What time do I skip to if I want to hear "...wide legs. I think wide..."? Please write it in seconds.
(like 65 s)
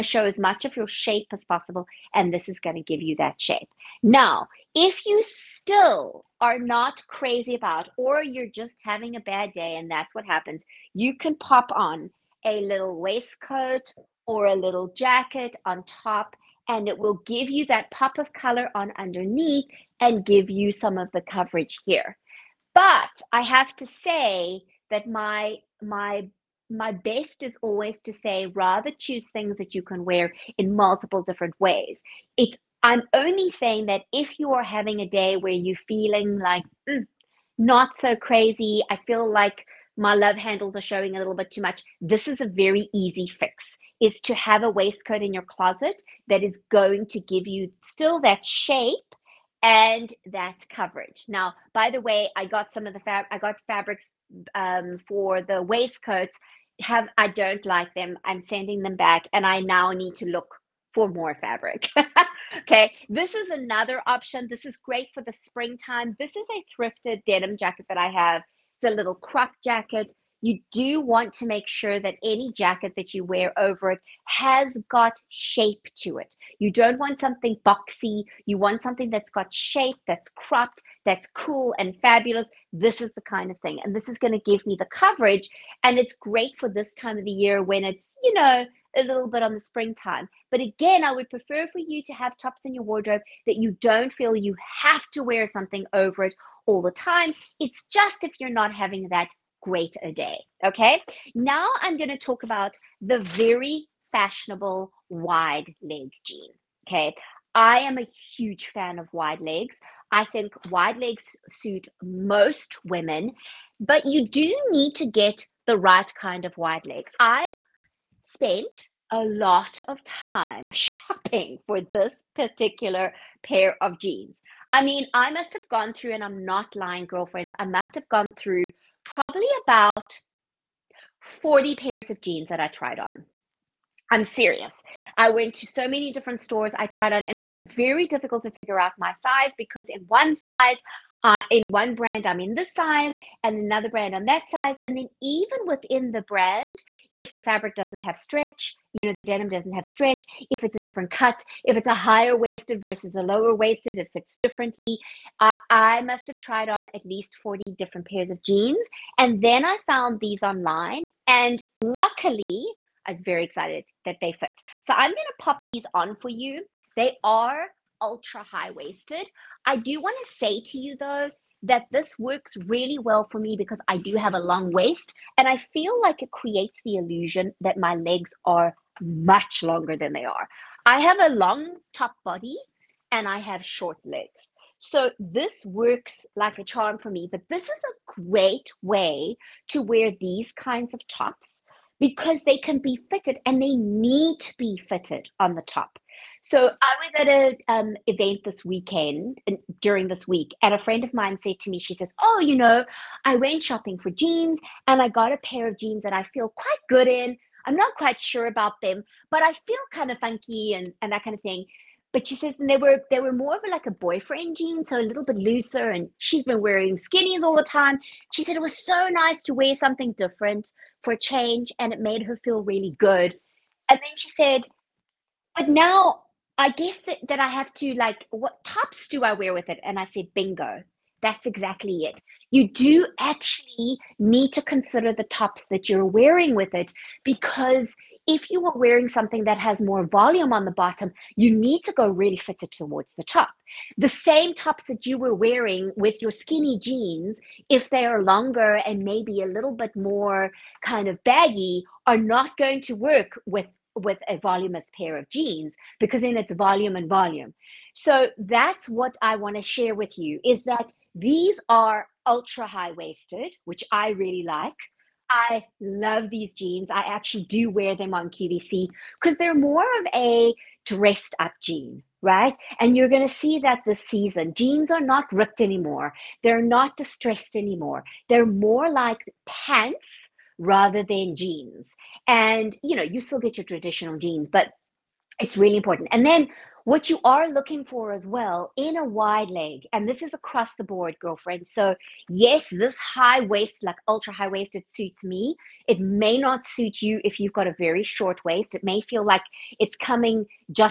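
109 s.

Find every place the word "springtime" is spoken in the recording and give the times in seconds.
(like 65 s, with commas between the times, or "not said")
65 s, 89 s.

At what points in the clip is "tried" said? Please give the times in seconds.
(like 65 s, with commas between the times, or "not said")
132 s, 136 s, 156 s.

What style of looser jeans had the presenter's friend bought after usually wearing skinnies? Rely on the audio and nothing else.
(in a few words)
boyfriend jeans.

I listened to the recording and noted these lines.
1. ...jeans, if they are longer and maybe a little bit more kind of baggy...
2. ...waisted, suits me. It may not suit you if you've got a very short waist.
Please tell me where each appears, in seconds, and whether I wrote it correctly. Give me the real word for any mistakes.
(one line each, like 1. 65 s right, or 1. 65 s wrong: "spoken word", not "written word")
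1. 246 s right
2. 294 s right.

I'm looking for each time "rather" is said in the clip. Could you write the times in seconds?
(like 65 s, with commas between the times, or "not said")
28 s, 280 s.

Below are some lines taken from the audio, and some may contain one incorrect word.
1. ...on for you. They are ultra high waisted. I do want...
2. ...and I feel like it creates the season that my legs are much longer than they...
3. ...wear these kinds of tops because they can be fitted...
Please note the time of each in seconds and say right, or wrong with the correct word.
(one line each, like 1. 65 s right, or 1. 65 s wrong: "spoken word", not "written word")
1. 165 s right
2. 175 s wrong: "illusion", not "season"
3. 189 s right.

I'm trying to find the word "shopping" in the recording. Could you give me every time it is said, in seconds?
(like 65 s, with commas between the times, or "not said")
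120 s, 203 s.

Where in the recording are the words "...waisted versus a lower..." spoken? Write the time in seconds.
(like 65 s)
152 s.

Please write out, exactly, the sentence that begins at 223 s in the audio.
And then she said, but now I guess that, that I have to like, what tops do I wear with it?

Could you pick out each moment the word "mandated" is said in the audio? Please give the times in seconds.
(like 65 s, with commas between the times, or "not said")
not said.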